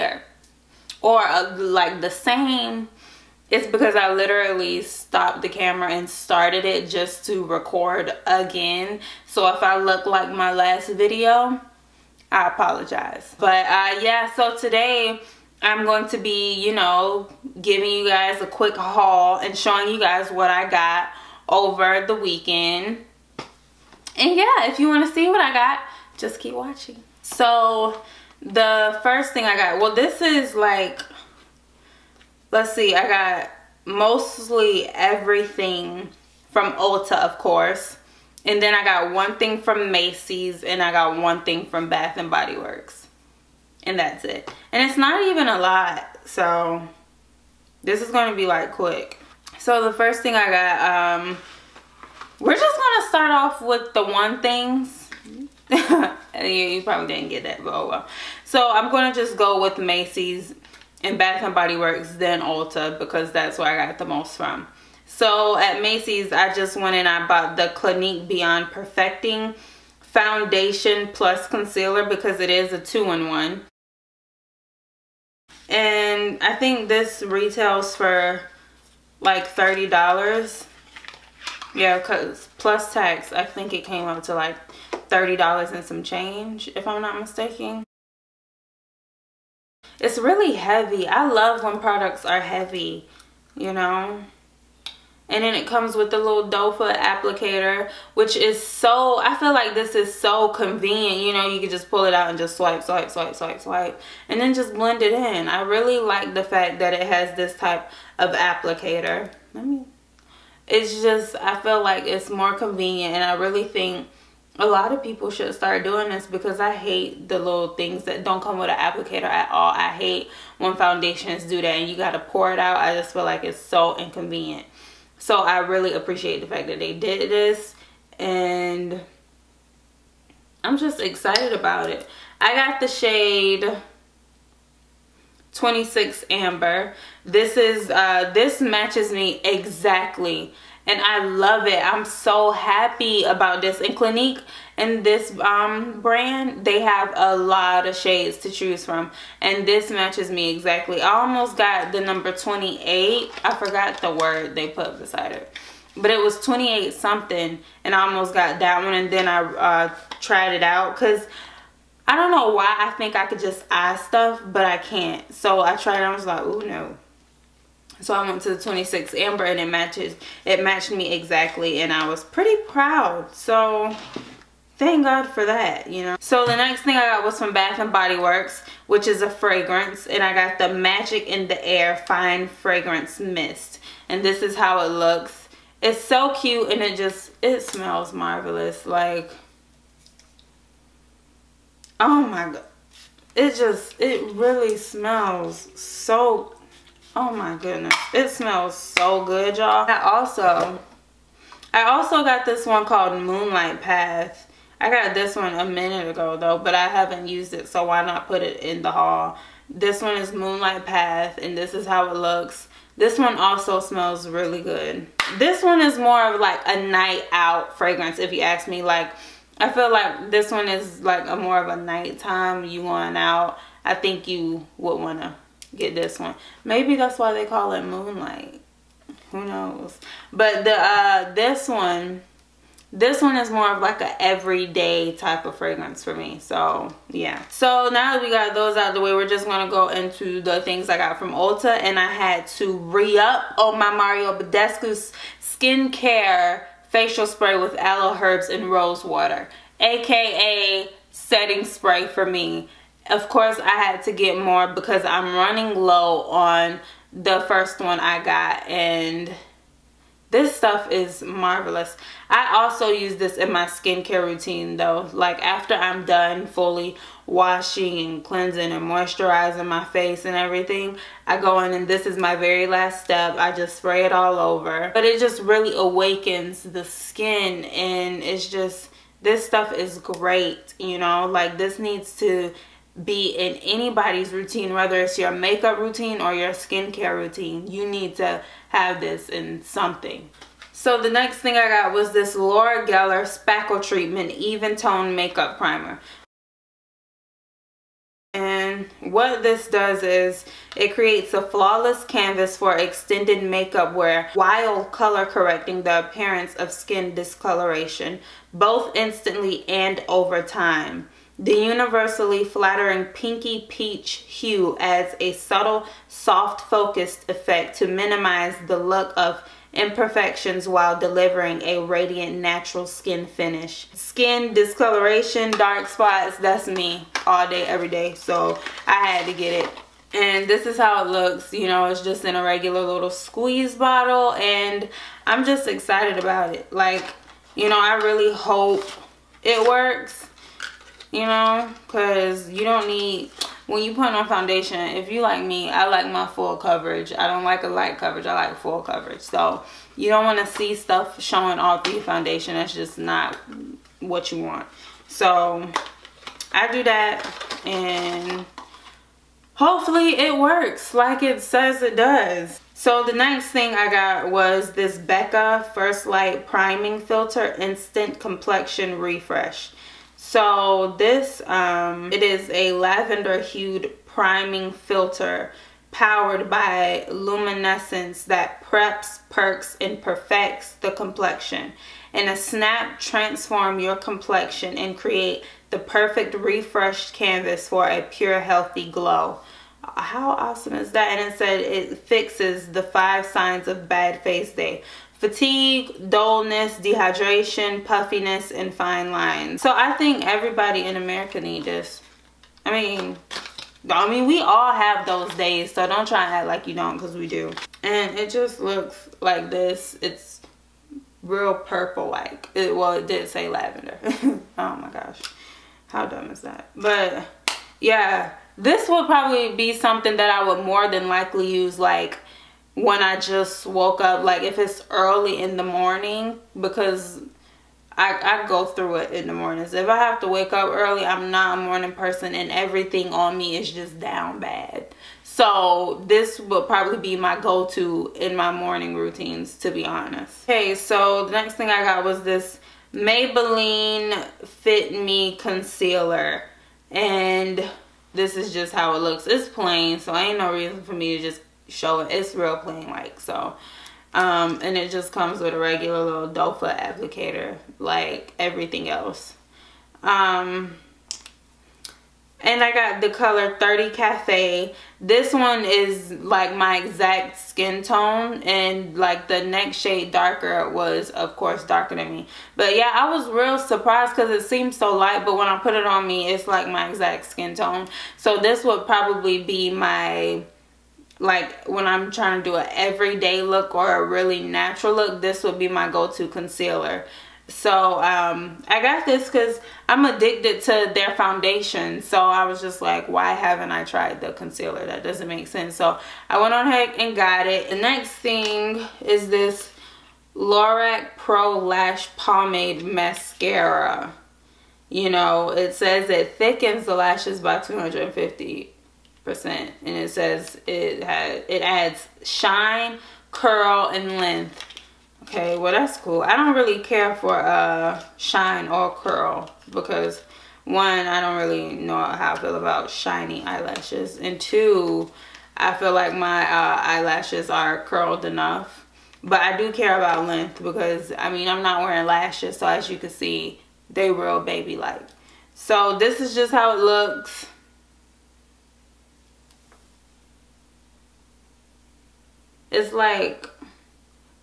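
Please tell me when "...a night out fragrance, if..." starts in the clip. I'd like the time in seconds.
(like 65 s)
216 s.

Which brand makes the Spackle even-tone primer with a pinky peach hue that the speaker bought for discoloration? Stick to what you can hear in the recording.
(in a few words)
Laura Geller.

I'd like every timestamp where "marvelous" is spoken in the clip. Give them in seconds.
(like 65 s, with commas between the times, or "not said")
188 s, 261 s.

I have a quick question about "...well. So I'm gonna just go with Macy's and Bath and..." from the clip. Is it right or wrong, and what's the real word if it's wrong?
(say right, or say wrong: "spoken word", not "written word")
right.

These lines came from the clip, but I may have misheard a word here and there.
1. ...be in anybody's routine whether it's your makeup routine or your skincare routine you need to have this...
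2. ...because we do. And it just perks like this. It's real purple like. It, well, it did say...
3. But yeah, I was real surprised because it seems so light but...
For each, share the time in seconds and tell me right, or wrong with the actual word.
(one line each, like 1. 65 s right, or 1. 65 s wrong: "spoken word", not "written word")
1. 283 s right
2. 406 s wrong: "looks", not "perks"
3. 472 s right.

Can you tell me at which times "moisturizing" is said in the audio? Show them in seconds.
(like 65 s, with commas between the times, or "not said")
268 s.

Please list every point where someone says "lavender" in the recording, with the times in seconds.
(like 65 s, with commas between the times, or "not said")
372 s, 413 s.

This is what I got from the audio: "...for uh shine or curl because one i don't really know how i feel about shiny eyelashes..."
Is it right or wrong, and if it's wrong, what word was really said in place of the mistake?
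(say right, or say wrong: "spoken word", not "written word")
right.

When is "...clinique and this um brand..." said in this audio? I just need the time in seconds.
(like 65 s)
143 s.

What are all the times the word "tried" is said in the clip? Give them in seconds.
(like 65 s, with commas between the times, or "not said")
160 s, 165 s, 493 s.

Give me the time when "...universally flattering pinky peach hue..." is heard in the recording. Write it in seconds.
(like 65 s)
311 s.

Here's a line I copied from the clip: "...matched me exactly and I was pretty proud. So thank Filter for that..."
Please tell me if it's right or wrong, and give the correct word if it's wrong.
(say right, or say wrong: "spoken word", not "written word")
wrong: "God", not "Filter".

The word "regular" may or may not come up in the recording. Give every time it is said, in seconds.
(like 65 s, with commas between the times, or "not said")
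332 s, 455 s.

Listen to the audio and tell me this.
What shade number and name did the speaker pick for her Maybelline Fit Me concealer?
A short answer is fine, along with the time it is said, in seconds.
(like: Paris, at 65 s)
30 Cafe, at 463 s.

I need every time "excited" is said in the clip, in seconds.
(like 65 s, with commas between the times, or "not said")
131 s, 335 s.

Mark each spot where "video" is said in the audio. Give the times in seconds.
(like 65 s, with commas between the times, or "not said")
10 s.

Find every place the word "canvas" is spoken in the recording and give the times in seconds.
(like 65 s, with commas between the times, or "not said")
302 s, 387 s.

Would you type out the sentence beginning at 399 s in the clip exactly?
So I think everybody in America need this.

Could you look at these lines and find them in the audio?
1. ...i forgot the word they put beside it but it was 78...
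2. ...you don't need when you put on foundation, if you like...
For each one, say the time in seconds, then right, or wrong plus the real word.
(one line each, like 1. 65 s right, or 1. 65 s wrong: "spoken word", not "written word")
1. 153 s wrong: "28", not "78"
2. 342 s right.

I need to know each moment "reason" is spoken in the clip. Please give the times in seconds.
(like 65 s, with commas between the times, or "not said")
450 s.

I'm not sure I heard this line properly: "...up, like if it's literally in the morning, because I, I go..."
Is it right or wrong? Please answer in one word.
wrong.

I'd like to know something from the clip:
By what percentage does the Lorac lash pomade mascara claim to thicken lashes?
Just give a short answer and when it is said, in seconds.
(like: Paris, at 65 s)
250 percent, at 507 s.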